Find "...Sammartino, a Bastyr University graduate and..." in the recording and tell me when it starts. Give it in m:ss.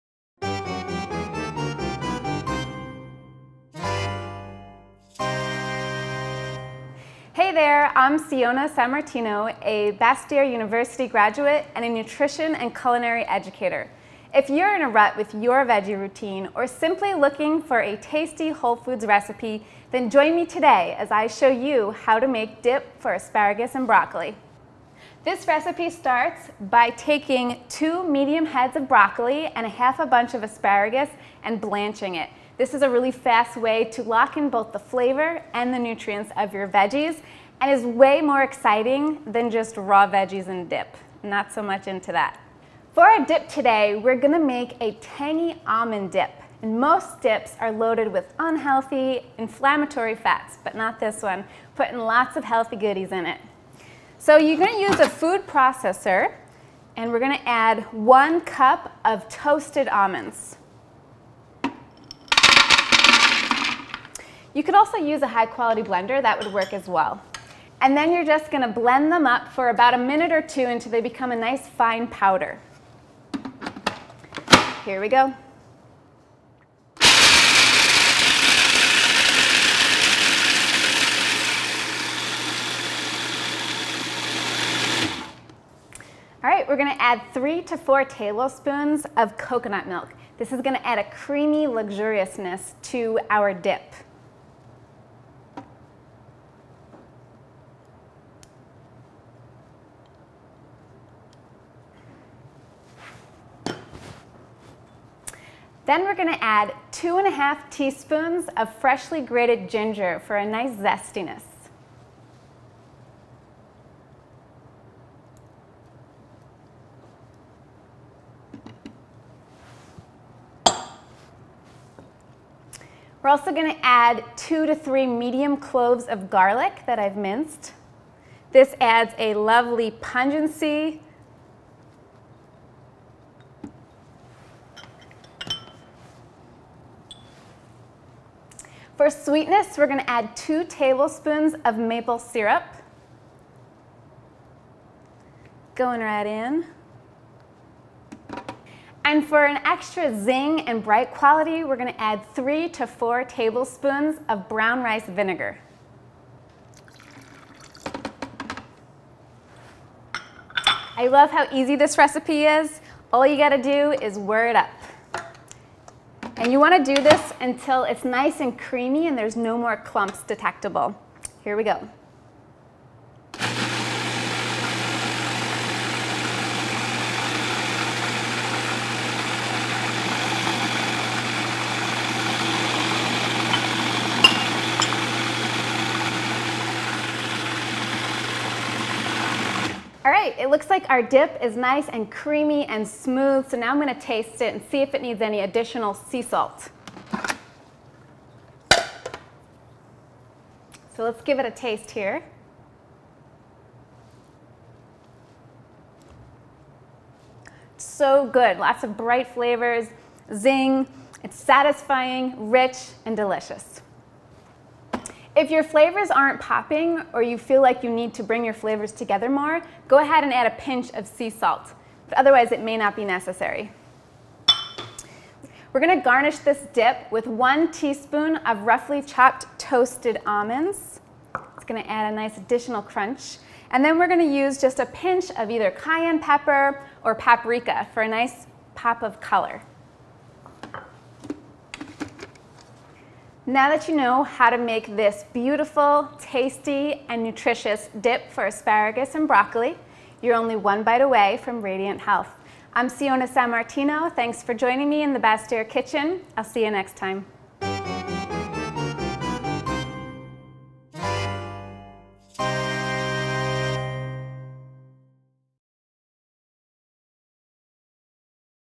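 0:08.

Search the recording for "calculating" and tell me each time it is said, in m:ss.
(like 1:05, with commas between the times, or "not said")
not said.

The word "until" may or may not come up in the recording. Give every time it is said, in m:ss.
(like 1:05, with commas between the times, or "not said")
1:10, 2:47.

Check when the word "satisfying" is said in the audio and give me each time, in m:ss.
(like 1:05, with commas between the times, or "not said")
3:31.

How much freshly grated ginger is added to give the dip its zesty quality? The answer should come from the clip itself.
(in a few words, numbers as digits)
2.5 teaspoons.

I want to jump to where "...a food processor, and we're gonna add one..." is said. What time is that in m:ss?
0:54.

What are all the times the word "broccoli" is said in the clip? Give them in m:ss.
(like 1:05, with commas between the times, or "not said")
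0:23, 0:28, 4:09.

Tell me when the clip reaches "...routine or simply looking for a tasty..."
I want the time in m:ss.
0:15.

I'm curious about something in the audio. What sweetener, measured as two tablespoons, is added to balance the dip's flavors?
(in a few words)
maple syrup.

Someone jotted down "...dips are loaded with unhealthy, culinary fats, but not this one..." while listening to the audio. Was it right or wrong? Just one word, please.
wrong.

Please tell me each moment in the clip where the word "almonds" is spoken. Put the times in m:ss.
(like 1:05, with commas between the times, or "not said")
0:45, 0:59, 3:50.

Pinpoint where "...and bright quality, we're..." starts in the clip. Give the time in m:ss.
2:30.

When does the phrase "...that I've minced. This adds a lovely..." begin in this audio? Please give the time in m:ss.
2:06.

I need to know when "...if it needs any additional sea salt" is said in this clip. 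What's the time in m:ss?
3:14.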